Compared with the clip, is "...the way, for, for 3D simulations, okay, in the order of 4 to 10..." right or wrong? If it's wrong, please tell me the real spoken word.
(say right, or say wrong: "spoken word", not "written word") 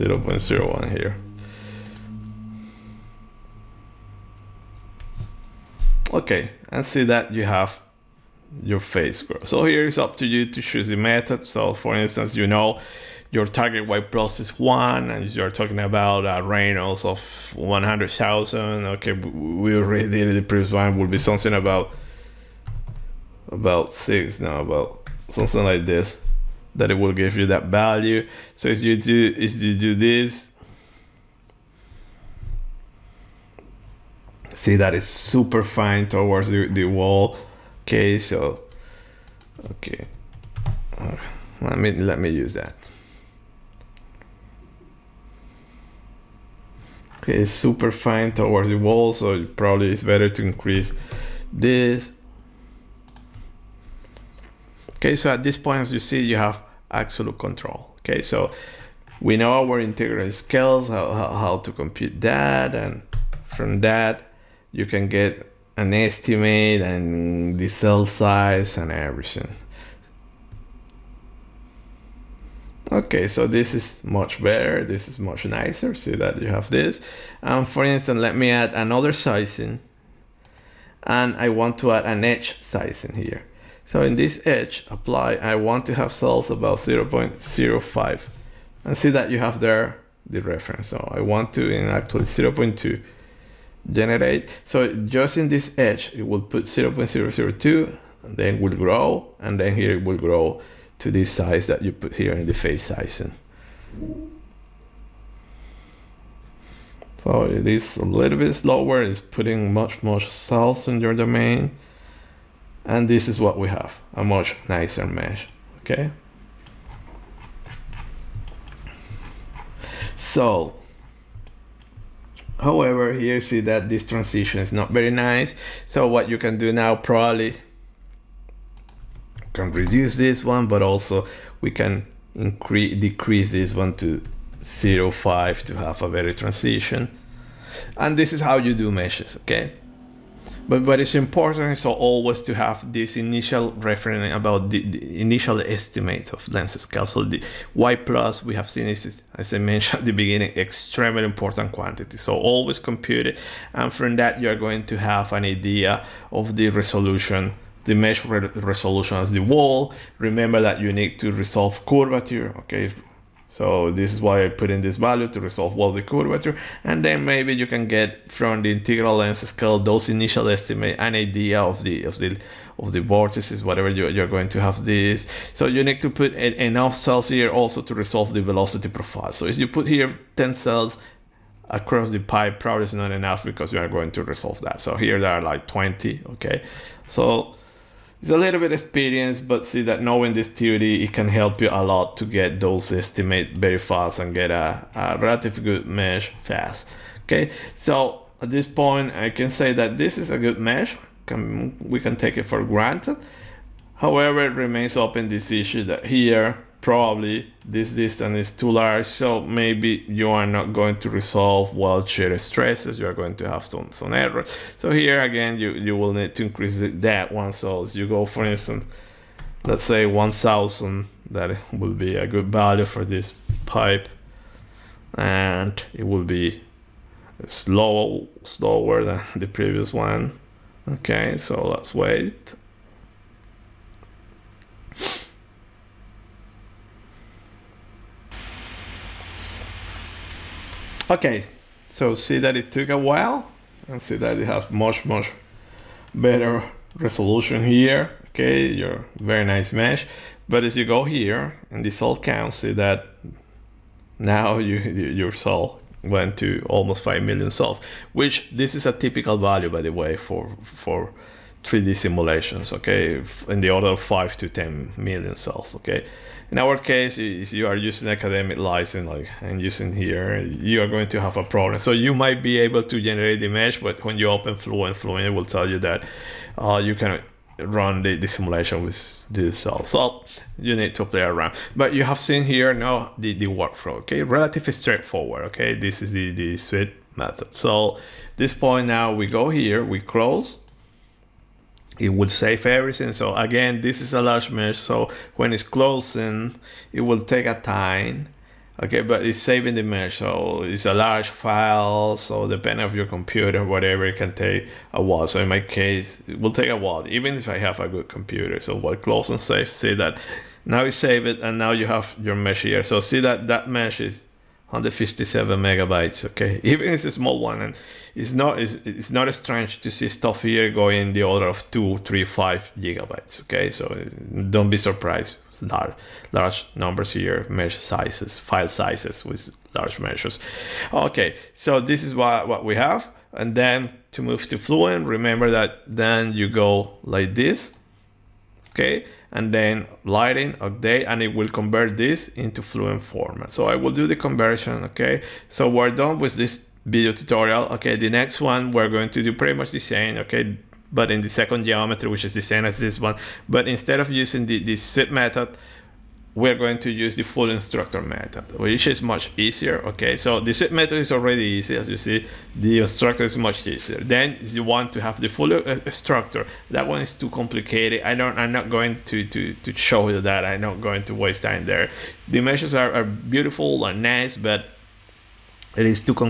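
wrong: "5", not "4".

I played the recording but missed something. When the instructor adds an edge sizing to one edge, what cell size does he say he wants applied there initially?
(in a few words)
0.05.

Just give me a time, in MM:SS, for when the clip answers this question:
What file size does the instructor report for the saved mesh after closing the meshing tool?
05:14.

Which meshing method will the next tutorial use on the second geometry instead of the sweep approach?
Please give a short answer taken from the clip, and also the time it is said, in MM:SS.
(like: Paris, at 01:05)
full unstructured method, at 05:57.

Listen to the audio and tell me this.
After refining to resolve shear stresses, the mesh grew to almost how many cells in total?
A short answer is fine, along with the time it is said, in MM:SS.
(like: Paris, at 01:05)
5 million, at 04:16.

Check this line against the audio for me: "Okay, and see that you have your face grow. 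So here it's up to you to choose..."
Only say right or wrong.
right.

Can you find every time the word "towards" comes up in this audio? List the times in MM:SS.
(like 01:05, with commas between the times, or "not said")
00:36, 00:48.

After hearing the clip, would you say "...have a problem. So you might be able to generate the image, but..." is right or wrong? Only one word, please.
right.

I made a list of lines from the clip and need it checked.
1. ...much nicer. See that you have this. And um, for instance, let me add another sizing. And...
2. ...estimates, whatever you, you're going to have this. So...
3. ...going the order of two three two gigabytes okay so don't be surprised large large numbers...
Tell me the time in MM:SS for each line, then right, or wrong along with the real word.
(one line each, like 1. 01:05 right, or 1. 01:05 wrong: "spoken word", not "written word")
1. 01:15 right
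2. 02:52 wrong: "vortices", not "estimates"
3. 05:20 wrong: "five", not "two".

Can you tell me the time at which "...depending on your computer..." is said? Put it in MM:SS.
05:02.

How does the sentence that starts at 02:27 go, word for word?
So the Y plus we have seen is, as I mentioned at the beginning, extremely important quantity.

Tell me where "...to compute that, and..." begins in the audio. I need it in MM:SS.
01:01.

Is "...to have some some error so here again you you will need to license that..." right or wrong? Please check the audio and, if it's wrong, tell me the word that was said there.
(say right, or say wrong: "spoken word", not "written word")
wrong: "increase", not "license".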